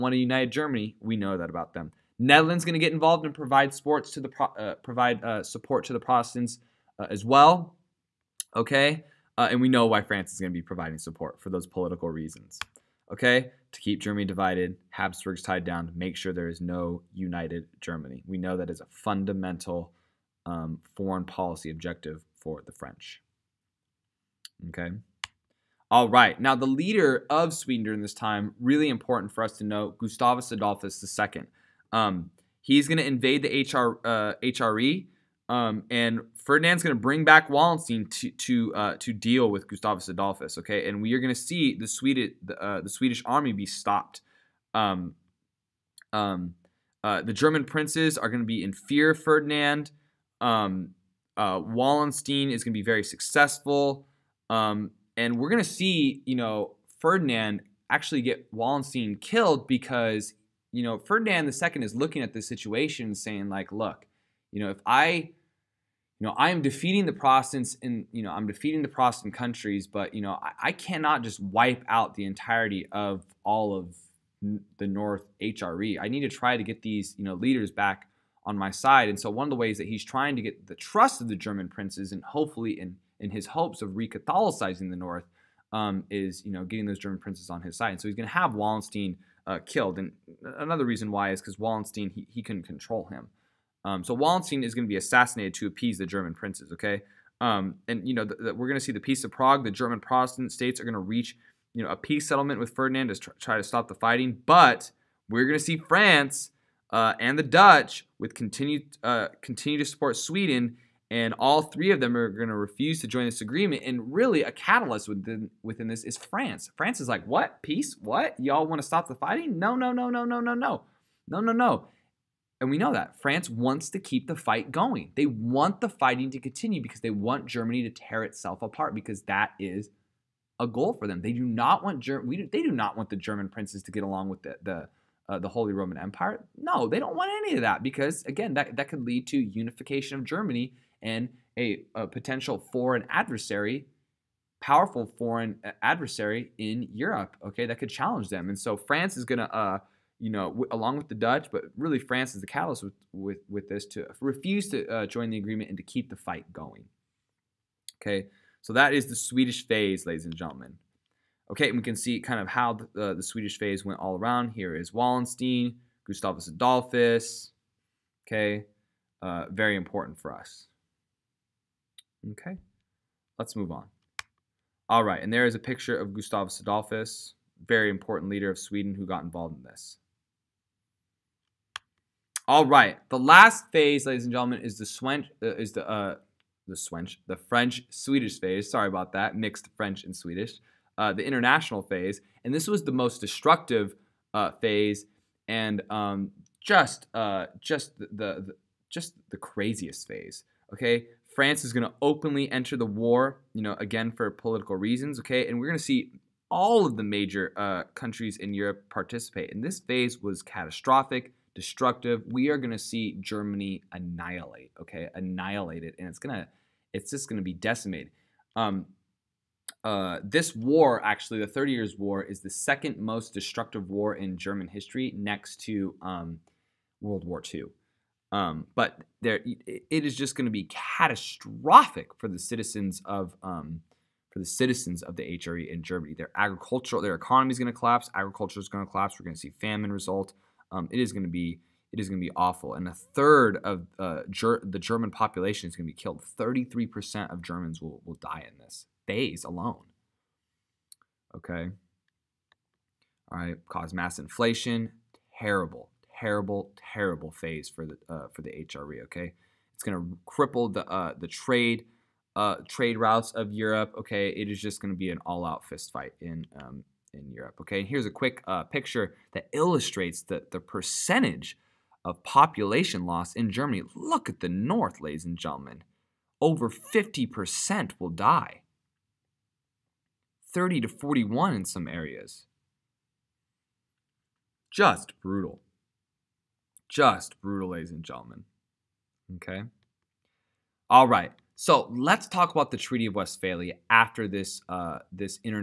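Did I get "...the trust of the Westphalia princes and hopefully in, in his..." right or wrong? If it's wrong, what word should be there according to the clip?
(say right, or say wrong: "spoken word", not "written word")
wrong: "German", not "Westphalia".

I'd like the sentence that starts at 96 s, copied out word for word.
Okay, um, and you know we're going to see the Peace of Prague.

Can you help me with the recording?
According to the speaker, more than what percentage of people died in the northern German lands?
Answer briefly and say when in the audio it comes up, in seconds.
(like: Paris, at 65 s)
50%, at 276 s.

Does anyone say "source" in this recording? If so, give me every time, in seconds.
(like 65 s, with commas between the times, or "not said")
not said.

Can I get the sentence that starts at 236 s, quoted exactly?
Their agricultural, their economy is going to collapse.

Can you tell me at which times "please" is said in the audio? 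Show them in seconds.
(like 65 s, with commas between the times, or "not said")
not said.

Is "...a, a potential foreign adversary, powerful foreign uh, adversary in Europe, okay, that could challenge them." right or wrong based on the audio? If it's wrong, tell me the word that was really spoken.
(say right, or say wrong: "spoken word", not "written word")
right.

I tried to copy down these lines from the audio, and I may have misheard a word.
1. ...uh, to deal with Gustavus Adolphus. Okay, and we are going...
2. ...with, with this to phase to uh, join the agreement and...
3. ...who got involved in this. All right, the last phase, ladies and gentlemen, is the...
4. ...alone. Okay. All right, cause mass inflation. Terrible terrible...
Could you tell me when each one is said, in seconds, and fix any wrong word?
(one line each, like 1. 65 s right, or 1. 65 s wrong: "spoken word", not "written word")
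1. 38 s right
2. 153 s wrong: "refuse", not "phase"
3. 178 s right
4. 249 s right.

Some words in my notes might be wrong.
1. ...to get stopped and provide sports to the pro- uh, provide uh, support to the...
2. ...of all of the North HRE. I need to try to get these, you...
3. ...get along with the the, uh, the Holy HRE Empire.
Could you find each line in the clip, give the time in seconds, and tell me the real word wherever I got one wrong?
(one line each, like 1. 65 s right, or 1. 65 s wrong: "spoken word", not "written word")
1. 2 s wrong: "involved", not "stopped"
2. 72 s right
3. 133 s wrong: "Roman", not "HRE".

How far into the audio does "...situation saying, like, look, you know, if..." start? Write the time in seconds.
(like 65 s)
62 s.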